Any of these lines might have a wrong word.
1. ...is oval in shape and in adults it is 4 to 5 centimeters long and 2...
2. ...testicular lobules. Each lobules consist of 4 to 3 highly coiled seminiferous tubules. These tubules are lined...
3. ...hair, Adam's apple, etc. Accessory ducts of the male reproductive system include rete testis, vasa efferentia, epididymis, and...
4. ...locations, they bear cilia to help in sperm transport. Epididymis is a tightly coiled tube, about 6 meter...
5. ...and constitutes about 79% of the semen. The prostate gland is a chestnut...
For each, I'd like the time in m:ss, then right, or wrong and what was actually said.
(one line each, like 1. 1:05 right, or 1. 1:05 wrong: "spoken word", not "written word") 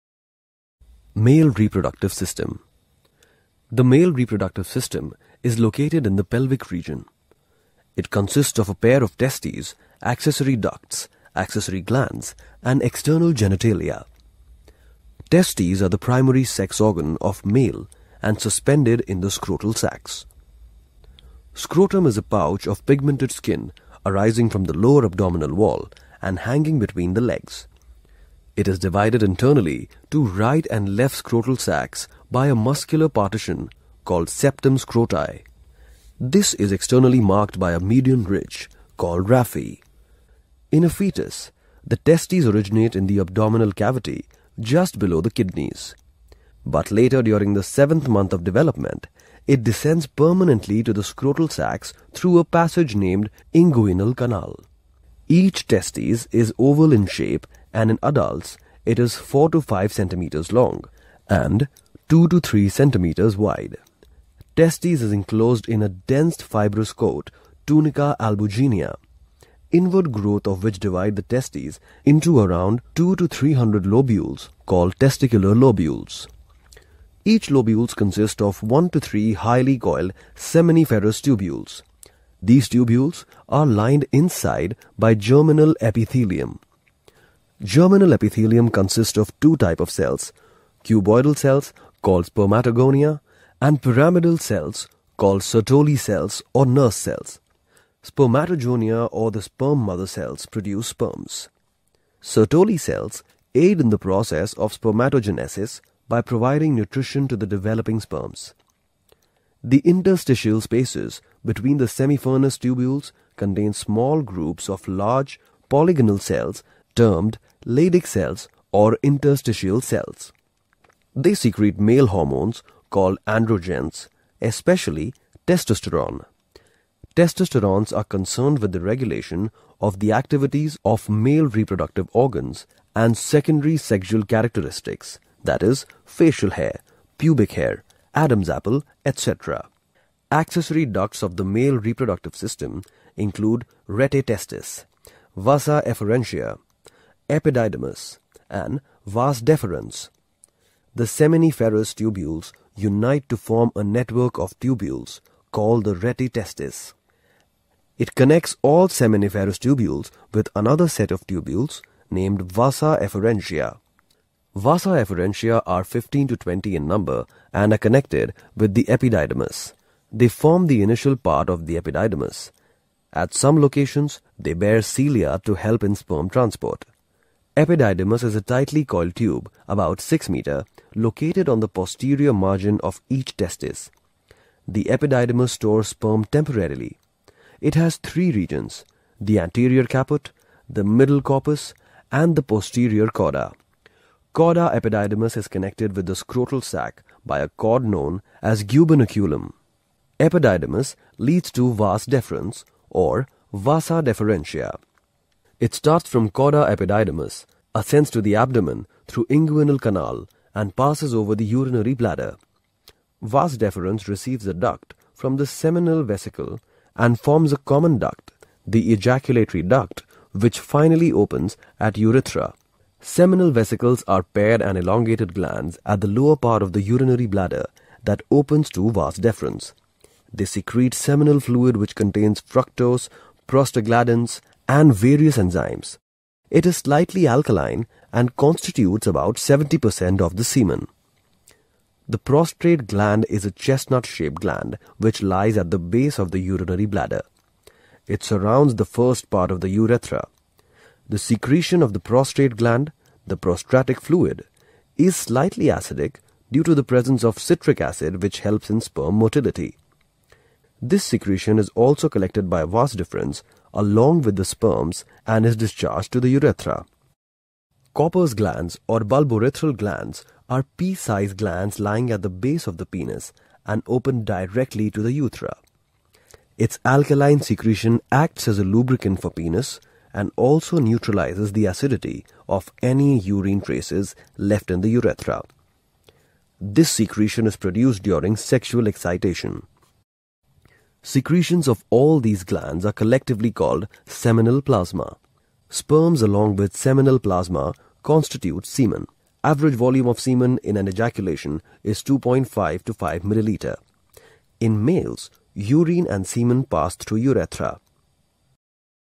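1. 0:56 right
2. 1:14 wrong: "1", not "4"
3. 2:17 right
4. 2:53 right
5. 3:58 wrong: "70", not "79".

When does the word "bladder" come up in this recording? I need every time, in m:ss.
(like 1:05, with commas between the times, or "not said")
3:31, 3:47, 4:06.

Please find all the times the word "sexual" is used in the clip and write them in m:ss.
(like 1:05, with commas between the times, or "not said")
2:13, 4:48.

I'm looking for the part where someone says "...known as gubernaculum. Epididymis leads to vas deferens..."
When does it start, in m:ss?
3:17.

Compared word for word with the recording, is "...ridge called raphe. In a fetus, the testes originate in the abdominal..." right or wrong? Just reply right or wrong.
right.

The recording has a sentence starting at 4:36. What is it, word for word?
Its alkaline secretion acts as a lubricant for penis and also neutralizes the acidity of any urine traces left in the urethra.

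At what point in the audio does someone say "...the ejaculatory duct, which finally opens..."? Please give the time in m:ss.
3:38.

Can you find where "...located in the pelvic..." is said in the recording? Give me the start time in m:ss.
0:05.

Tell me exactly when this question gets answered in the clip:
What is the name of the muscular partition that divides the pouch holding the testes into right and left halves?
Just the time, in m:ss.
0:34.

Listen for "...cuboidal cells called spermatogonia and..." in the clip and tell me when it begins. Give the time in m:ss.
1:30.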